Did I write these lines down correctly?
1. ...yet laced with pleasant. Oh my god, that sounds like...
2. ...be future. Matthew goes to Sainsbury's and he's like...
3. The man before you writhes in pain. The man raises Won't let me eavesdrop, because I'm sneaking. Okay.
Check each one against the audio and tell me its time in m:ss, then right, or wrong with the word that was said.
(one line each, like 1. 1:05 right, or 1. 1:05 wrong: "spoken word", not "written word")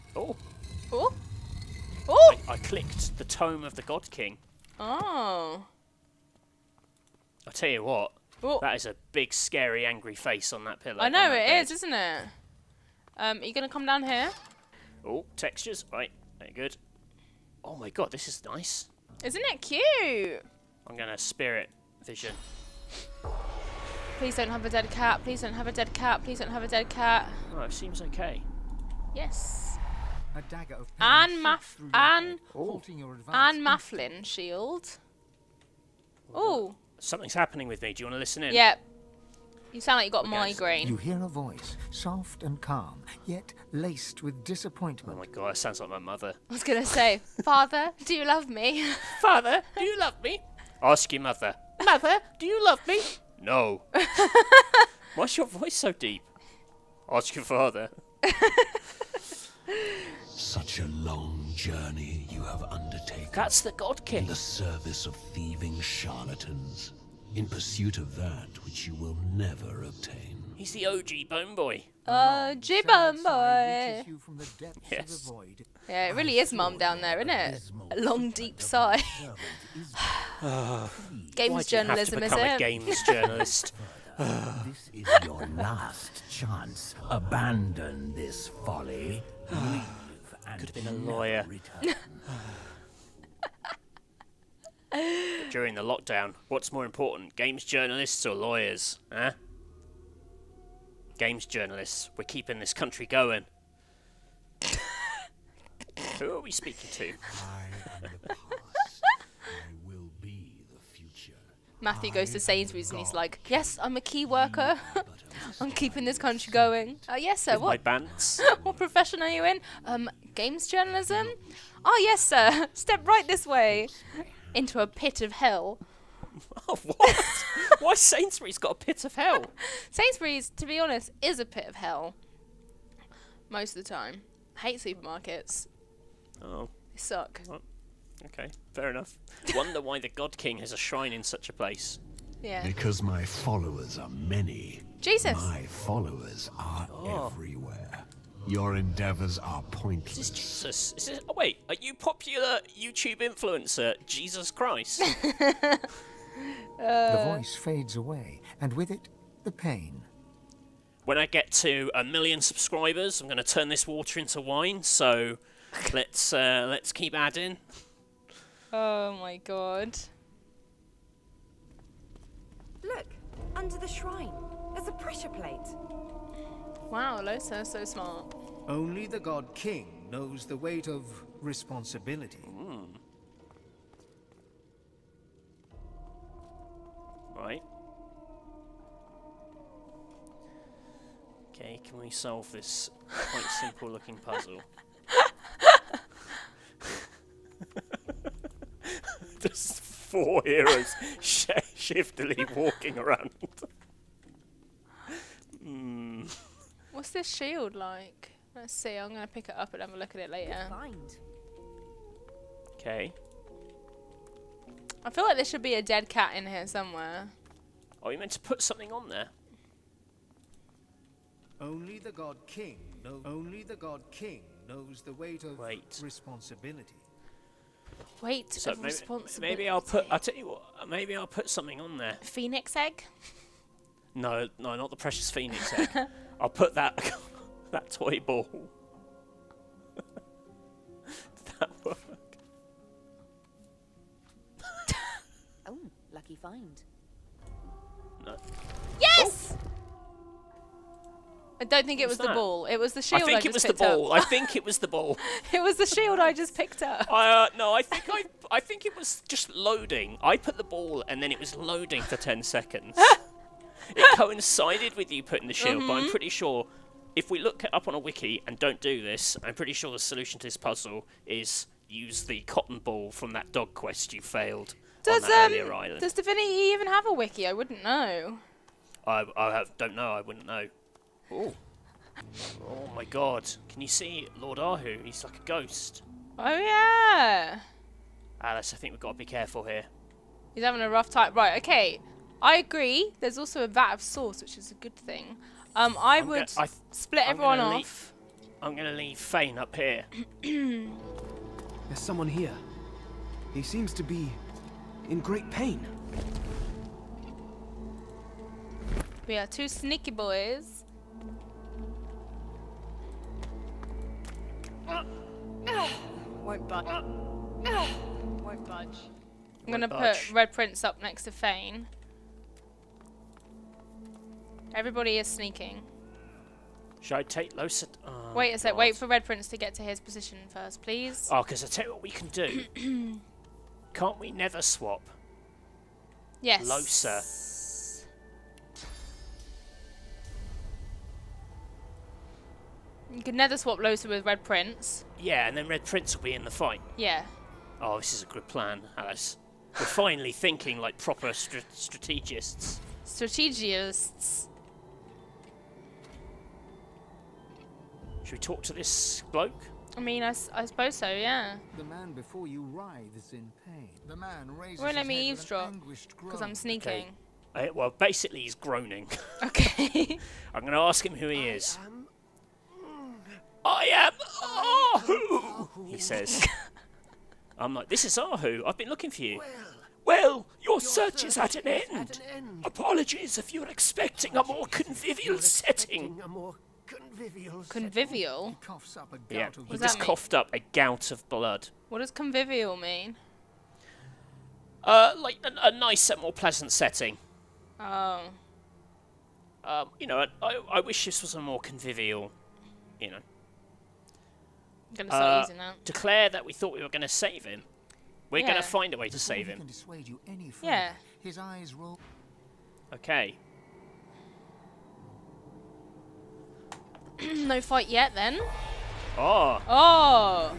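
1. 0:43 wrong: "disappointment", not "pleasant"
2. 1:50 right
3. 6:01 right.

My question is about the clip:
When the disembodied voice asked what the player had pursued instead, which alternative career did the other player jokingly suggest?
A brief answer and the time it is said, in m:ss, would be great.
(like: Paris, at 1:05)
Lawyer, at 1:30.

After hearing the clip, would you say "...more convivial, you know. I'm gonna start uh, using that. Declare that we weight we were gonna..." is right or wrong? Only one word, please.
wrong.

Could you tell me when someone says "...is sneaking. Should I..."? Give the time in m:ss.
5:25.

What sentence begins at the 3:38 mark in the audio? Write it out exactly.
Oh, you meant to put something on there.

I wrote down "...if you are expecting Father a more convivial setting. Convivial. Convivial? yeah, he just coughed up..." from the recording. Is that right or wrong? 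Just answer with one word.
wrong.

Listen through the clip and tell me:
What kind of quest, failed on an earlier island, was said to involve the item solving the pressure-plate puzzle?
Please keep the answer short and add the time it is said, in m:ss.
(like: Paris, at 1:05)
Dog quest, at 4:33.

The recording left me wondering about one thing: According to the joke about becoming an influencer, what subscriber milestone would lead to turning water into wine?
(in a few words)
1,000,000.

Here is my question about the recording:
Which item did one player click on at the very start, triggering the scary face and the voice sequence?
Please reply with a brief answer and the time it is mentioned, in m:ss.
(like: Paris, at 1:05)
Tome of the God King, at 0:03.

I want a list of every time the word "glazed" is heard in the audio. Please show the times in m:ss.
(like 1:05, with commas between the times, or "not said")
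not said.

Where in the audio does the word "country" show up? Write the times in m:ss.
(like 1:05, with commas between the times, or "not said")
1:42, 1:56.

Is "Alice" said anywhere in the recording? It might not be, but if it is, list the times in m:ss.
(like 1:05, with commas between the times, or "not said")
4:48, 5:48.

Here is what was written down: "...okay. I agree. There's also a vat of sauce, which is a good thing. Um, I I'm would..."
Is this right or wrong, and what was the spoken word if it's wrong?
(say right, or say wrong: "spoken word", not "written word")
right.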